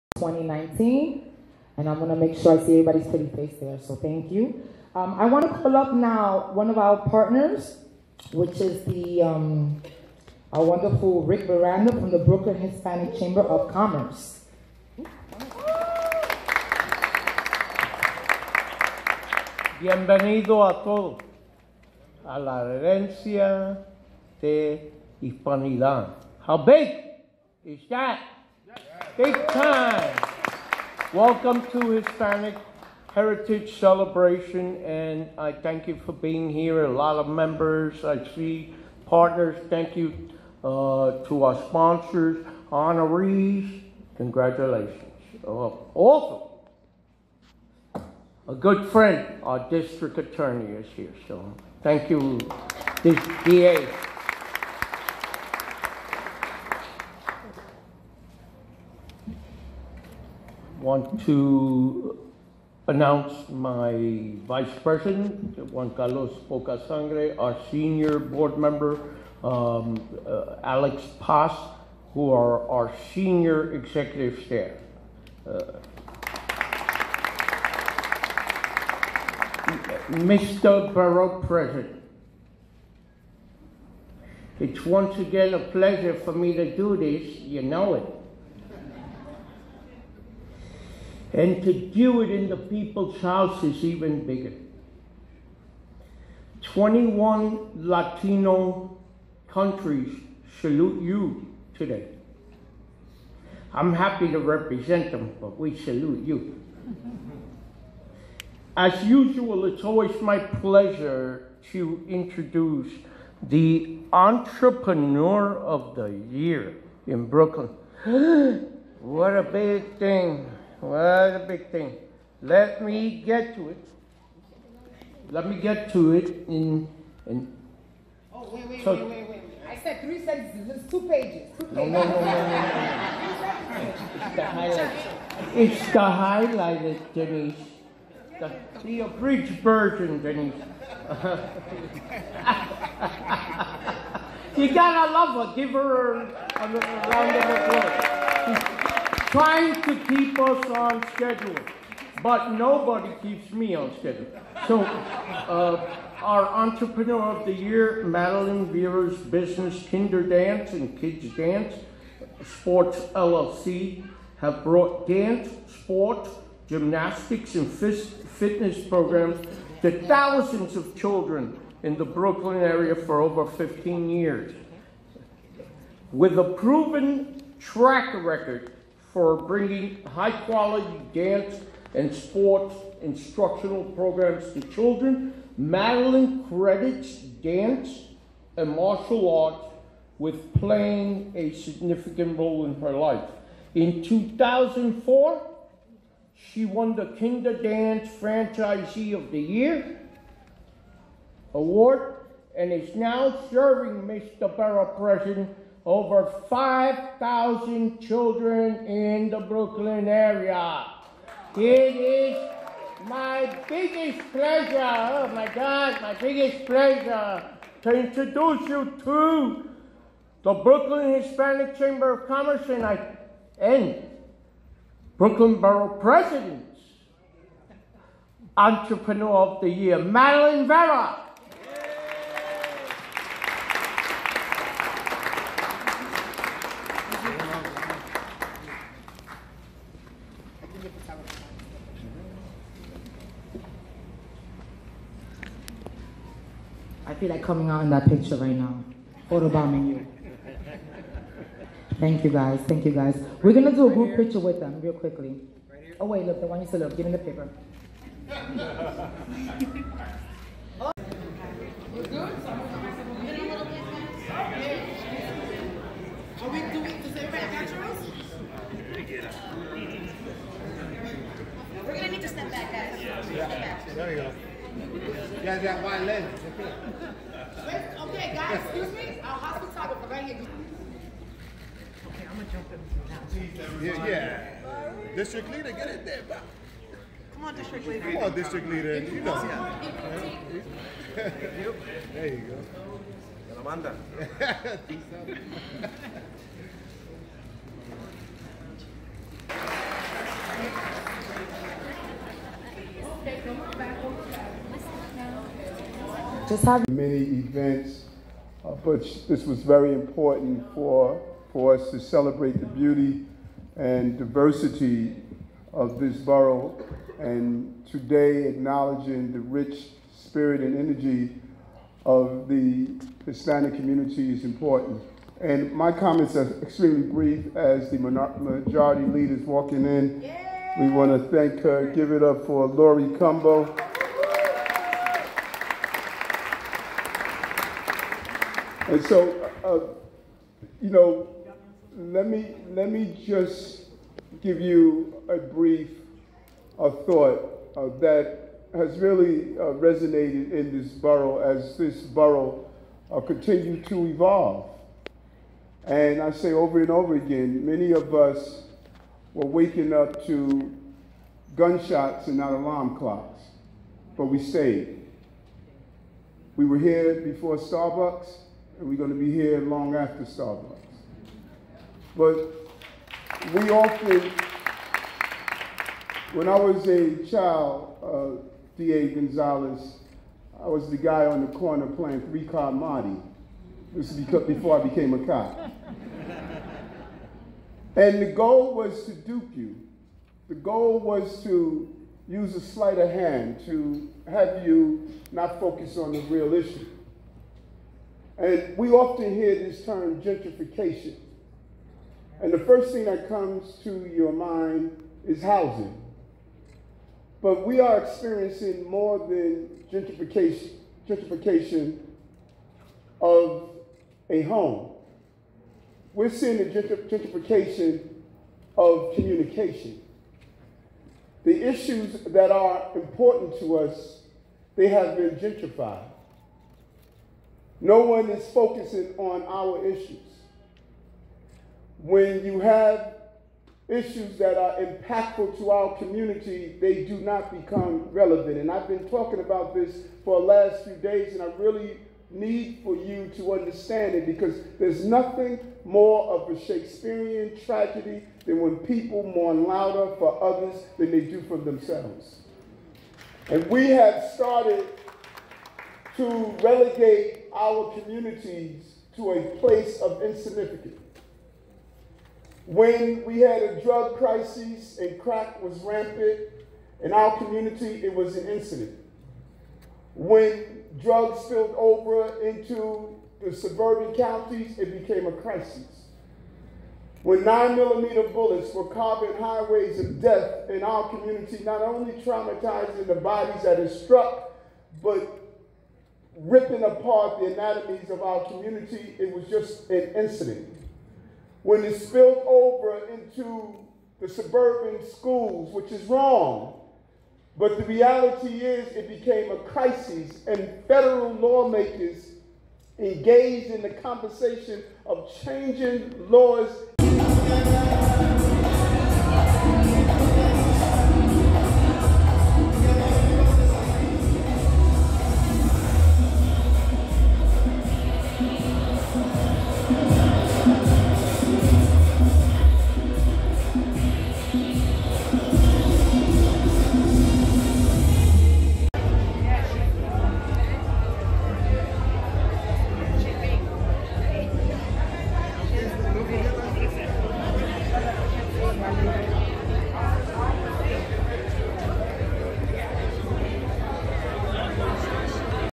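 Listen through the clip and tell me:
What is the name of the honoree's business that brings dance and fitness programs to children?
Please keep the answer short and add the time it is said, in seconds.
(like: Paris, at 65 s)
Kinder Dance and Kids Dance Sports LLC, at 159 s.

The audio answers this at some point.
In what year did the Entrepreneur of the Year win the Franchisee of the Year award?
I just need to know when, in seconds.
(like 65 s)
194 s.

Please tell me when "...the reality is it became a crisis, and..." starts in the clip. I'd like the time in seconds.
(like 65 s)
497 s.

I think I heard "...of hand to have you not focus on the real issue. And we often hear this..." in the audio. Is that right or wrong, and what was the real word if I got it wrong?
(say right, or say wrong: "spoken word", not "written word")
right.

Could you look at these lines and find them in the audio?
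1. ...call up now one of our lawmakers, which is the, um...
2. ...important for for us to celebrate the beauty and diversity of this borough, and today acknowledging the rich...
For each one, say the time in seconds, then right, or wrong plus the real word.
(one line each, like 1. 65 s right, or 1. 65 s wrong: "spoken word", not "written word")
1. 5 s wrong: "partners", not "lawmakers"
2. 309 s right.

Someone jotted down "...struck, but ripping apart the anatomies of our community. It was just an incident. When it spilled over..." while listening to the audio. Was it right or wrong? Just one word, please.
right.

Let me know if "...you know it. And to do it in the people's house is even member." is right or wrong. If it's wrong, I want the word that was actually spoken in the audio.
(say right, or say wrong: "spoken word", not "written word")
wrong: "bigger", not "member".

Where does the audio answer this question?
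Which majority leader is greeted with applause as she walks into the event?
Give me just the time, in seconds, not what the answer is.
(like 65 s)
332 s.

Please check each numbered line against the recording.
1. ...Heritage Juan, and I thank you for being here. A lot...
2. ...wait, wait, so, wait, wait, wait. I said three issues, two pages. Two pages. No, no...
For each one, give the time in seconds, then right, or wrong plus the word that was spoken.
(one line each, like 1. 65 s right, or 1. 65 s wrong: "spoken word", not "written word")
1. 33 s wrong: "Celebration", not "Juan"
2. 128 s wrong: "sentences", not "issues".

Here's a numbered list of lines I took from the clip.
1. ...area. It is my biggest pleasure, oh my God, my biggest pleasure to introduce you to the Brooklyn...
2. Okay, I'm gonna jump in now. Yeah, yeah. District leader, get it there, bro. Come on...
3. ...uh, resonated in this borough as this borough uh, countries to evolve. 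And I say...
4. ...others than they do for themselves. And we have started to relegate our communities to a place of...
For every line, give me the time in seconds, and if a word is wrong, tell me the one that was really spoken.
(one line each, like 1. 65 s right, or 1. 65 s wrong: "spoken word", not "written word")
1. 210 s right
2. 282 s right
3. 349 s wrong: "continues", not "countries"
4. 450 s right.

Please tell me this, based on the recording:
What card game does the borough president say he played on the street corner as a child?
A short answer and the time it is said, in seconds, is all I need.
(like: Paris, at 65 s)
Three Card Monte, at 382 s.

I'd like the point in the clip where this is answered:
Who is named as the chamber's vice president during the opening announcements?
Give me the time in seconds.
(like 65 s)
65 s.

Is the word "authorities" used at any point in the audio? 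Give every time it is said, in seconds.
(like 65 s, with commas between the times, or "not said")
not said.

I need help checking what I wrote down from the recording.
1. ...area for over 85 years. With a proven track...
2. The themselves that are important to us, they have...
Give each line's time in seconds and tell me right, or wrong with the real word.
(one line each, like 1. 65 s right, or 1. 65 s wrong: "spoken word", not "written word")
1. 172 s wrong: "15", not "85"
2. 421 s wrong: "issues", not "themselves".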